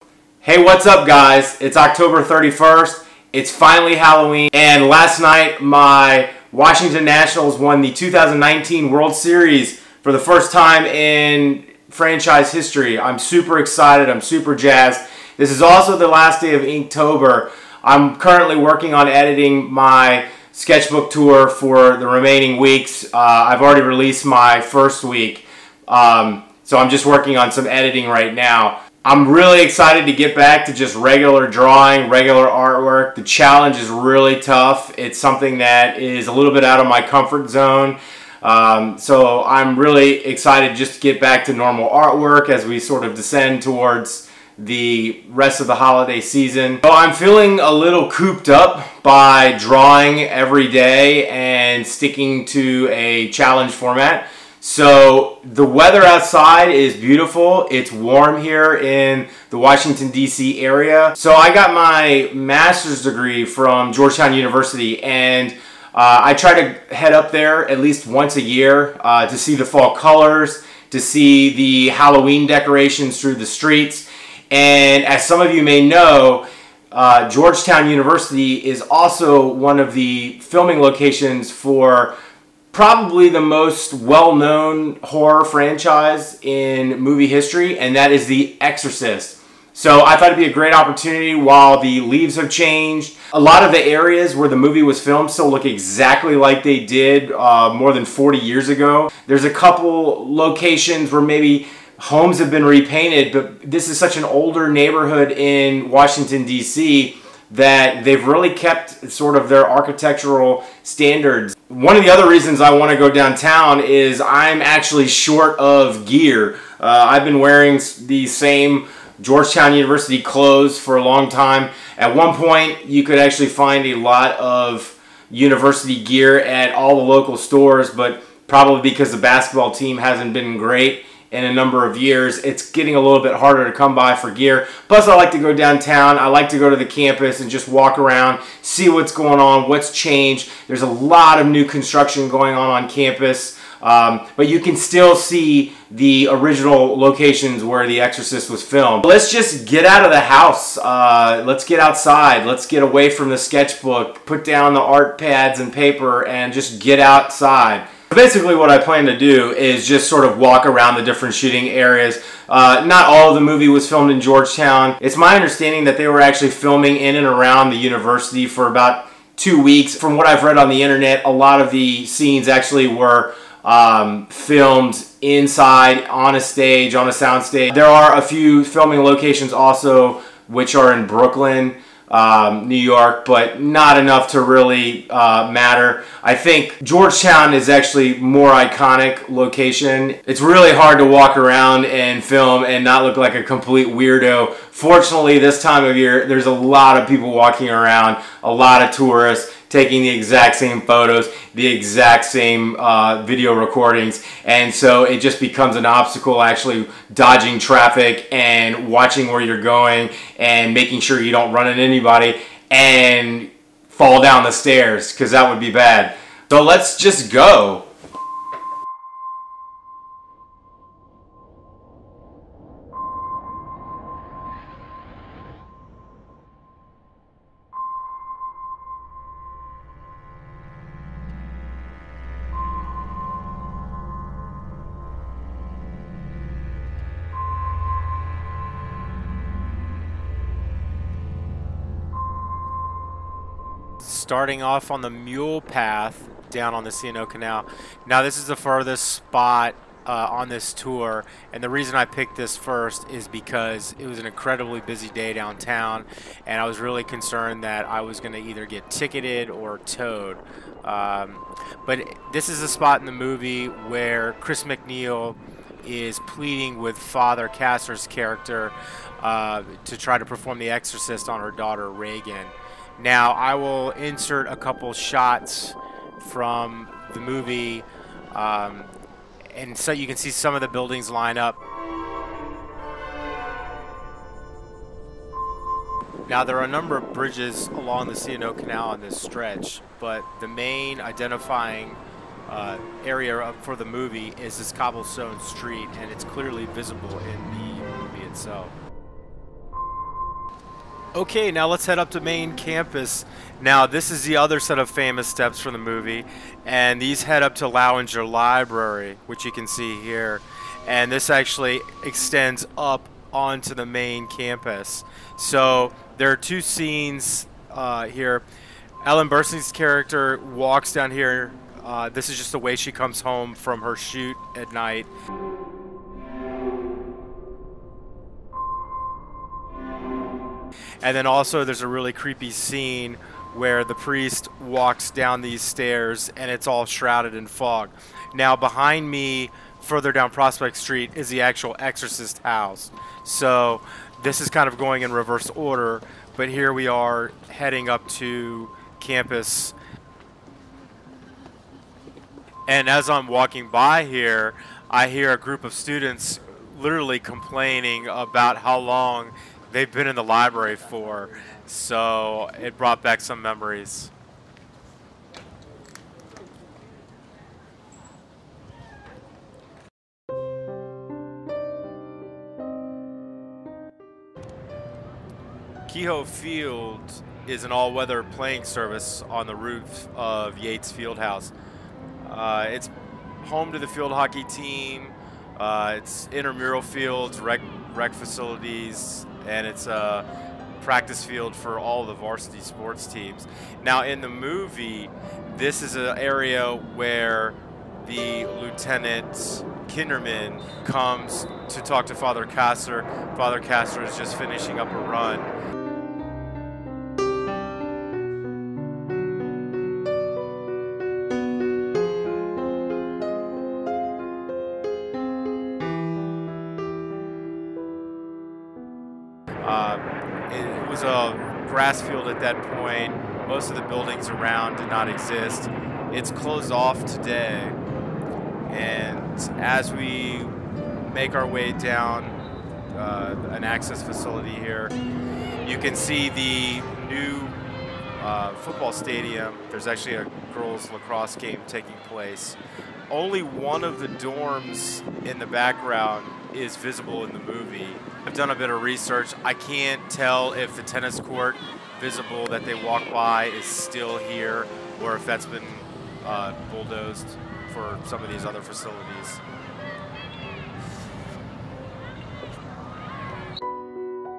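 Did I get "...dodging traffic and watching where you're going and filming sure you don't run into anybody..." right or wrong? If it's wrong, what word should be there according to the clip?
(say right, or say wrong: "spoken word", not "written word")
wrong: "making", not "filming".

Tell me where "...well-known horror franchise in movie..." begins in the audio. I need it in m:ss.
1:23.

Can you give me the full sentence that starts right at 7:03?
Most of the buildings around did not exist.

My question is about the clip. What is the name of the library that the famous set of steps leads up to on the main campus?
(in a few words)
Lauinger Library.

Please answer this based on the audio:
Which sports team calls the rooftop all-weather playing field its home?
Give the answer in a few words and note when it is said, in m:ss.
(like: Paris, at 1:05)
field hockey team, at 6:23.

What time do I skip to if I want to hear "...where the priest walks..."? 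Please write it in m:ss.
5:33.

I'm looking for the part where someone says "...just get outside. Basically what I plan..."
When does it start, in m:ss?
2:36.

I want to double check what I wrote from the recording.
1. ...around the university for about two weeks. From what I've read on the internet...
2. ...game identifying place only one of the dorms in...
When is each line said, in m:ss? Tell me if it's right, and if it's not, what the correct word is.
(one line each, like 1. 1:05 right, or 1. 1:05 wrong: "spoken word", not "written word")
1. 2:47 right
2. 7:21 wrong: "taking", not "identifying".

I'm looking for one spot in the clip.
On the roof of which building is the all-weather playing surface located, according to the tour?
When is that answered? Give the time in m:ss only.
6:20.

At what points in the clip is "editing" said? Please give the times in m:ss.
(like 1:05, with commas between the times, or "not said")
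0:19, 0:27.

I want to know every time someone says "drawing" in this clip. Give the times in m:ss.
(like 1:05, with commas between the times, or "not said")
0:31, 0:49.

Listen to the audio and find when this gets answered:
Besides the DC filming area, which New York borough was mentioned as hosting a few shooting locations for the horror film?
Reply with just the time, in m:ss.
3:01.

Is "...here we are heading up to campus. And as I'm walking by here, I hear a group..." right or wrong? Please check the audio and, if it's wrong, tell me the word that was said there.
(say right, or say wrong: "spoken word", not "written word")
right.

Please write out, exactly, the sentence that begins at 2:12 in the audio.
It's getting a little bit harder to come by for gear.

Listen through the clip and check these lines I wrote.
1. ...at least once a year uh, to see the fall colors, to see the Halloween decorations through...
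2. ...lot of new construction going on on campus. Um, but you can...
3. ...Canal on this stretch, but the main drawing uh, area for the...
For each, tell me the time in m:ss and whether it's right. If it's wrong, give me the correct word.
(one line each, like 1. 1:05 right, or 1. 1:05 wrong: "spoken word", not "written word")
1. 1:07 right
2. 2:20 right
3. 4:48 wrong: "identifying", not "drawing".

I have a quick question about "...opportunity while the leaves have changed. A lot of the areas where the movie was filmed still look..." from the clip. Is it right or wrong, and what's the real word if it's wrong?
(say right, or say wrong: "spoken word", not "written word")
right.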